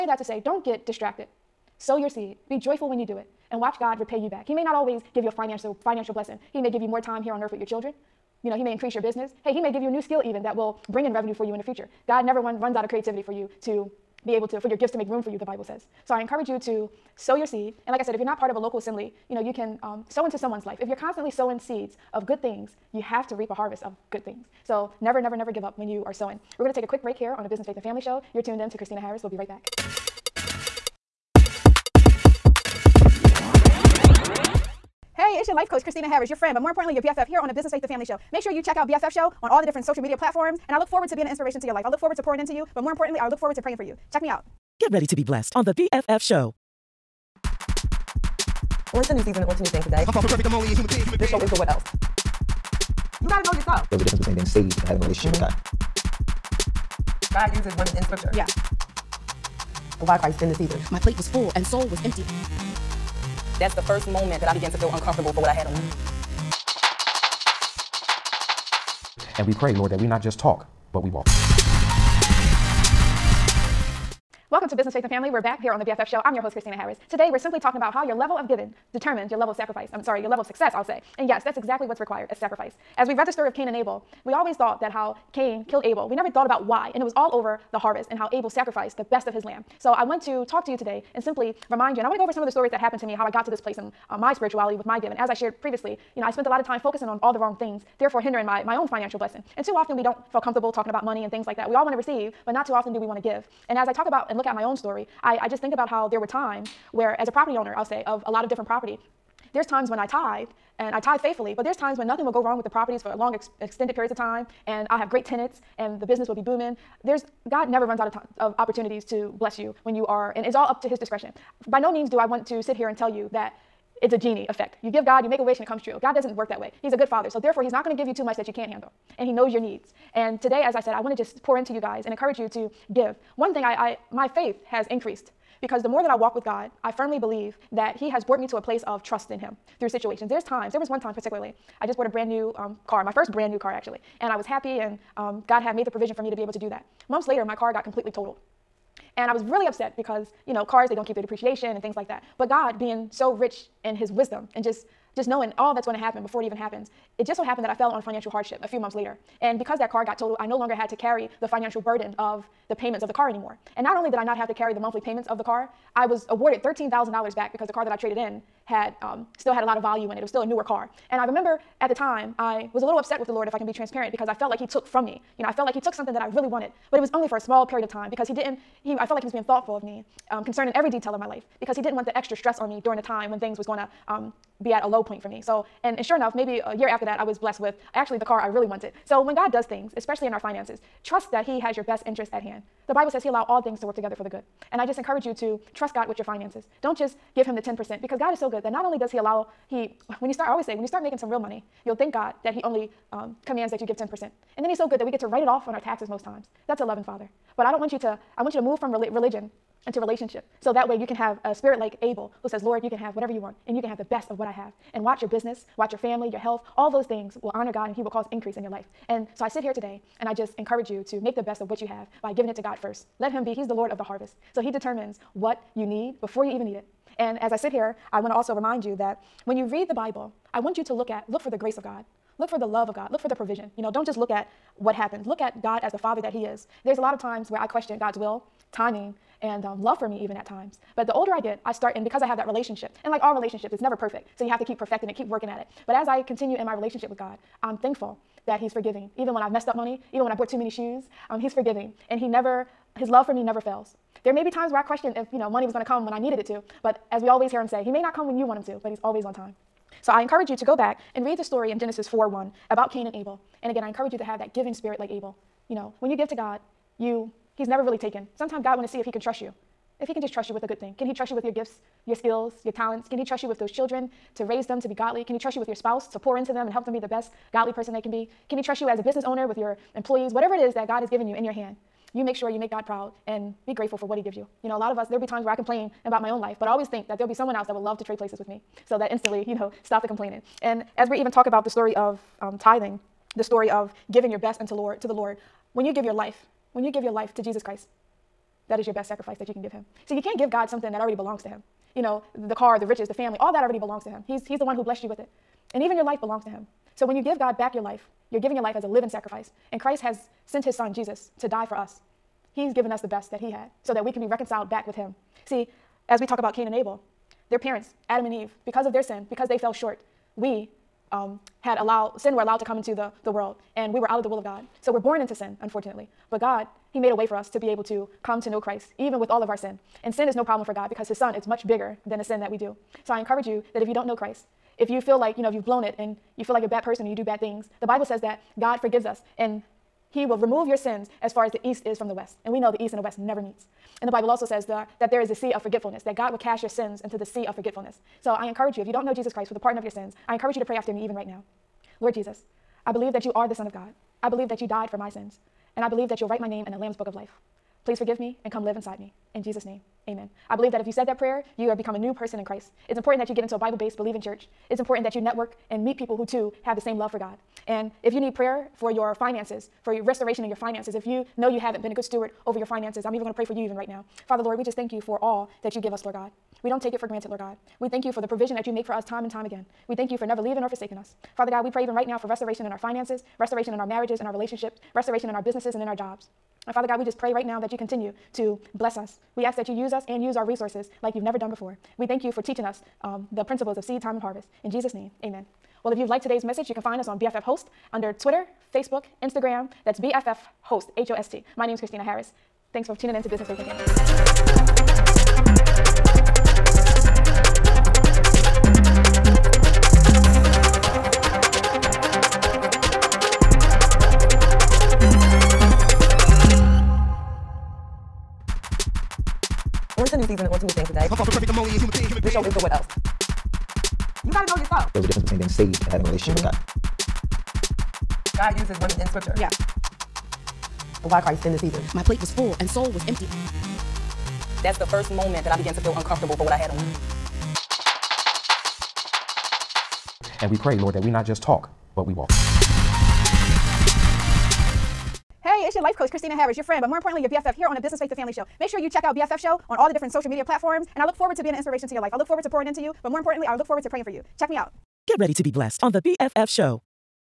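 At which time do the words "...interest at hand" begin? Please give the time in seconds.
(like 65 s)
192 s.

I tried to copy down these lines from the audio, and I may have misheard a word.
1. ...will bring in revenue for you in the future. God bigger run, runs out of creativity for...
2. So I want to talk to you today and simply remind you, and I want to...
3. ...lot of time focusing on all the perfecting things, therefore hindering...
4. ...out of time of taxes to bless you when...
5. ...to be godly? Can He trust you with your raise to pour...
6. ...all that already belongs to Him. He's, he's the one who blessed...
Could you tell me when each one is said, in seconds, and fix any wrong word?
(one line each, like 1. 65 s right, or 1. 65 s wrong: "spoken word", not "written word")
1. 10 s wrong: "never", not "bigger"
2. 89 s right
3. 96 s wrong: "wrong", not "perfecting"
4. 117 s wrong: "opportunities", not "taxes"
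5. 274 s wrong: "spouse", not "raise"
6. 303 s right.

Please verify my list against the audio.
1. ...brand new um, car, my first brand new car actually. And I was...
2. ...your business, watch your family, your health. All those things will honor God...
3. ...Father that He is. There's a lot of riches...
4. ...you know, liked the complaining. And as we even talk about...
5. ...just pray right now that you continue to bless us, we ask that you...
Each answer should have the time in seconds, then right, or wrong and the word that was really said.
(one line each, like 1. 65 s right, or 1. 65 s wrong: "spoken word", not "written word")
1. 142 s right
2. 215 s right
3. 235 s wrong: "times", not "riches"
4. 289 s wrong: "stopped", not "liked"
5. 387 s right.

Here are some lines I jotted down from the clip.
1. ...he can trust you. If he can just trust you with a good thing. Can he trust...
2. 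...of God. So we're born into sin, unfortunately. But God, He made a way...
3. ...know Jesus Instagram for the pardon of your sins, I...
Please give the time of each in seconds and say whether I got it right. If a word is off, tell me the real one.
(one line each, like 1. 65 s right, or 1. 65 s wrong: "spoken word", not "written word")
1. 269 s right
2. 324 s right
3. 349 s wrong: "Christ", not "Instagram".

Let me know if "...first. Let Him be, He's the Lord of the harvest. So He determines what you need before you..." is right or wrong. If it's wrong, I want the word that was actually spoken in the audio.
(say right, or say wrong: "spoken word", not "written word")
right.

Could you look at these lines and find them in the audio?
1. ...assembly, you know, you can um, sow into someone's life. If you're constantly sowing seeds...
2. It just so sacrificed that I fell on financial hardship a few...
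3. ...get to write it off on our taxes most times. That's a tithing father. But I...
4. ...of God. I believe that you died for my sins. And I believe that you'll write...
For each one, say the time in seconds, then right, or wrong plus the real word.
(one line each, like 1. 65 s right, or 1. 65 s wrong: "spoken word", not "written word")
1. 18 s right
2. 157 s wrong: "happened", not "sacrificed"
3. 205 s wrong: "loving", not "tithing"
4. 353 s right.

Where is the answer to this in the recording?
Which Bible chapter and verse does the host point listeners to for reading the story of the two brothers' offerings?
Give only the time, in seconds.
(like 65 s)
261 s.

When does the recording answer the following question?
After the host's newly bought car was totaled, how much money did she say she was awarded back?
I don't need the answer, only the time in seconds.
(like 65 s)
166 s.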